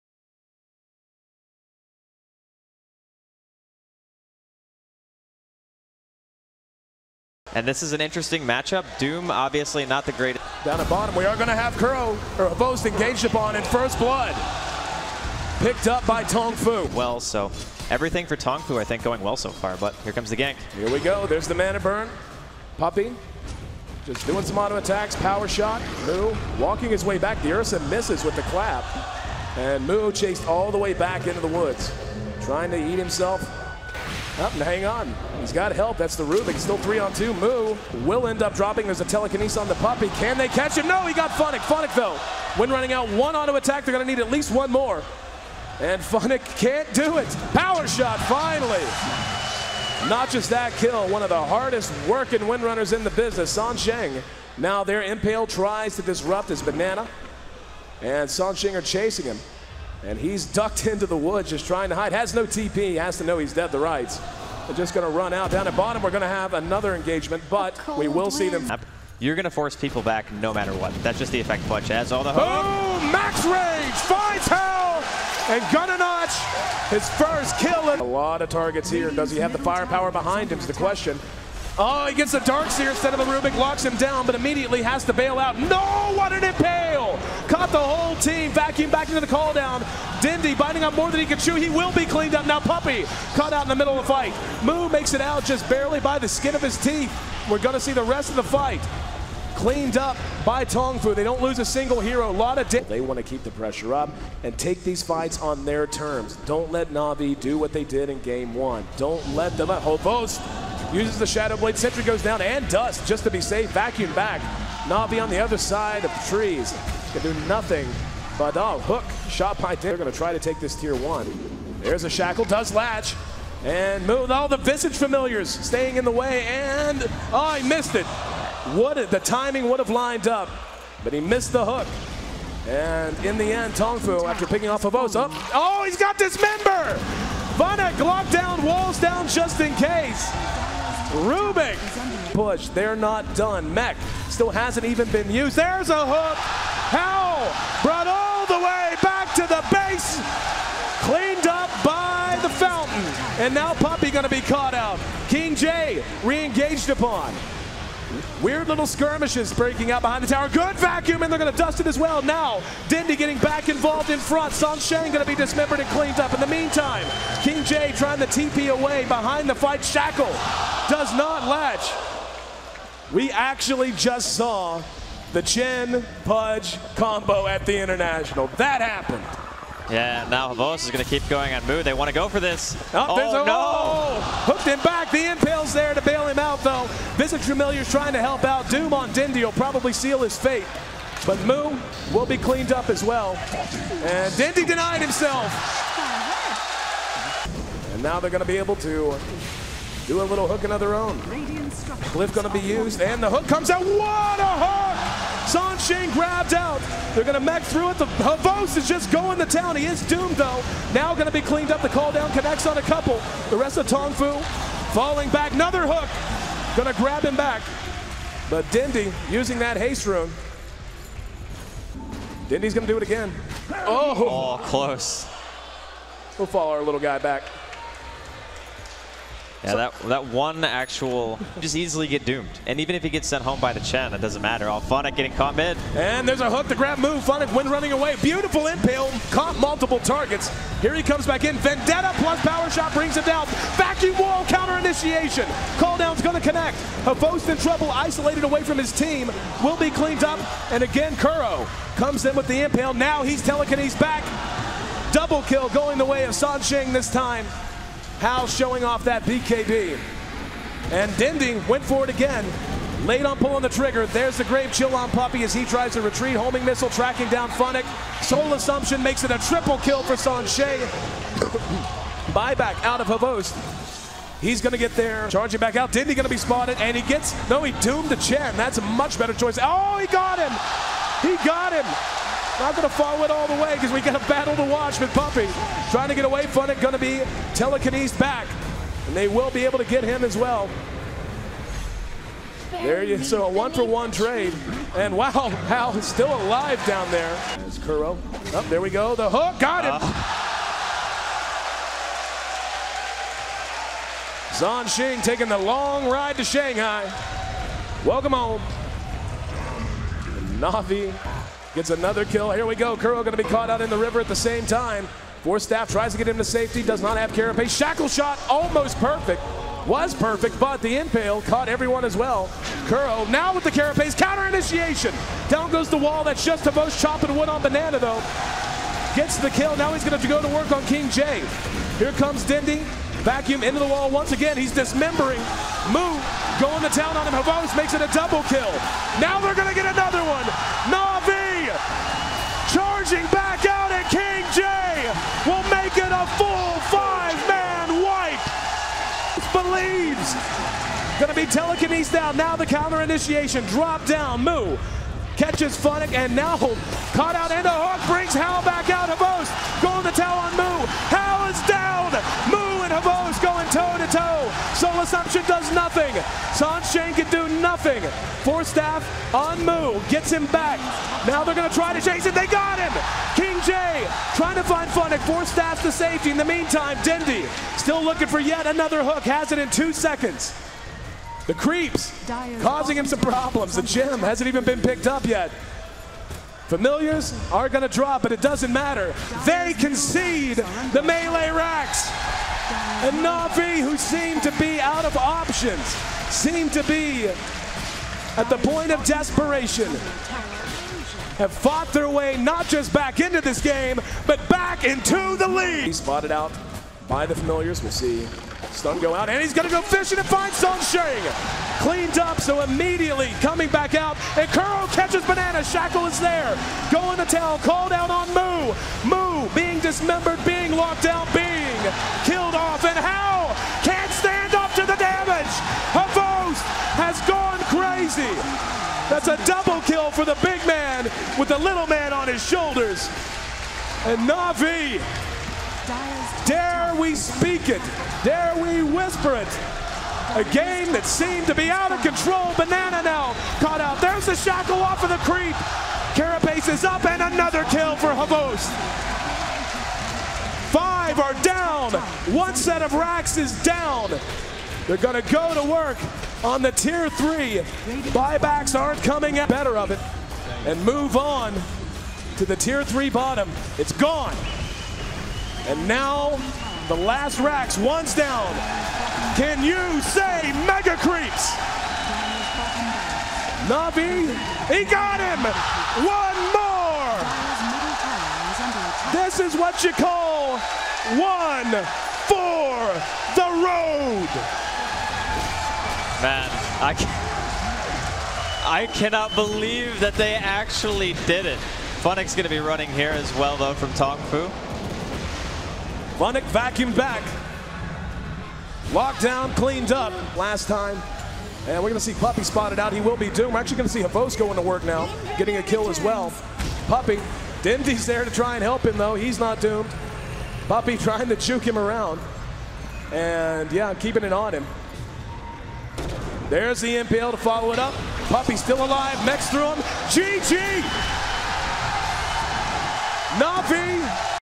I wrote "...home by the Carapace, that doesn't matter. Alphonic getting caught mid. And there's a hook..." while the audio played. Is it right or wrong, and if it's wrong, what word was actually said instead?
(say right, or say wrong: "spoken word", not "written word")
wrong: "Chen", not "Carapace".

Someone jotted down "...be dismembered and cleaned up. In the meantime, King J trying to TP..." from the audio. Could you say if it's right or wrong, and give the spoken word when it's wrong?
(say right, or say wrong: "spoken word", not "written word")
right.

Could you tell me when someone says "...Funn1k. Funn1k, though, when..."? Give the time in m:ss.
0:41.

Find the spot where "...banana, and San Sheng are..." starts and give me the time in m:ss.
0:56.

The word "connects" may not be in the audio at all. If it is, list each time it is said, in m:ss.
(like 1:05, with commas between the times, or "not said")
3:32, 4:06.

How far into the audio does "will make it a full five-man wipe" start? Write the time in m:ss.
5:45.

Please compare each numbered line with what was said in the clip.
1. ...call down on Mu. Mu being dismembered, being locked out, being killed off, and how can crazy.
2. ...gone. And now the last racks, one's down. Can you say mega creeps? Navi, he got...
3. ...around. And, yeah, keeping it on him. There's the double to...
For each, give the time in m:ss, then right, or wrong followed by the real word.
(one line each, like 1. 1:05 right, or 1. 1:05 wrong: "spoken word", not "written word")
1. 6:57 right
2. 7:43 right
3. 8:31 wrong: "impale", not "double".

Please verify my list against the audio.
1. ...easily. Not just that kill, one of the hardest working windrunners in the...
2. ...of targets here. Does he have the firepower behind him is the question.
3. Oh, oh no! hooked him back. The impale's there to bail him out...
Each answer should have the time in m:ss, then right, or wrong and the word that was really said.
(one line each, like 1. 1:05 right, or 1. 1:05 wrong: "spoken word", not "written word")
1. 0:48 wrong: "finally", not "easily"
2. 1:18 right
3. 3:02 right.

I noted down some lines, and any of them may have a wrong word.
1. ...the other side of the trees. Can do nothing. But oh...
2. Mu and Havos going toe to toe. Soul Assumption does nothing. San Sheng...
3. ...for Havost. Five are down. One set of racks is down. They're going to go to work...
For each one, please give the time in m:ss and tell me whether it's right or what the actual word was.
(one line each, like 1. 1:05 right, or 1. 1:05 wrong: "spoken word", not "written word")
1. 1:55 right
2. 6:02 right
3. 7:27 right.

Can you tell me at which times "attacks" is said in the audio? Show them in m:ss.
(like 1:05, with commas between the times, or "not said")
0:24, 0:43.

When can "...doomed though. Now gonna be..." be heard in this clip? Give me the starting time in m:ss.
3:30.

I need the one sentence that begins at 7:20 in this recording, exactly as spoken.
A game that seemed to be out of control.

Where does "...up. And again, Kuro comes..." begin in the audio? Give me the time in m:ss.
4:10.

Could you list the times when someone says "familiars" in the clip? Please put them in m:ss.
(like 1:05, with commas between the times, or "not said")
2:04, 3:07, 6:26, 6:47.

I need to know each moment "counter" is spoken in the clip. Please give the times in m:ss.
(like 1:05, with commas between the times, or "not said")
4:04, 5:24, 5:52.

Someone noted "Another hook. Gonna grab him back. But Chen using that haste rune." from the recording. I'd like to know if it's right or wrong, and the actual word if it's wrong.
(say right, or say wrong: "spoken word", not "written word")
wrong: "Dendi", not "Chen".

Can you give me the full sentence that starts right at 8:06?
Man, I, I cannot believe that they actually did it.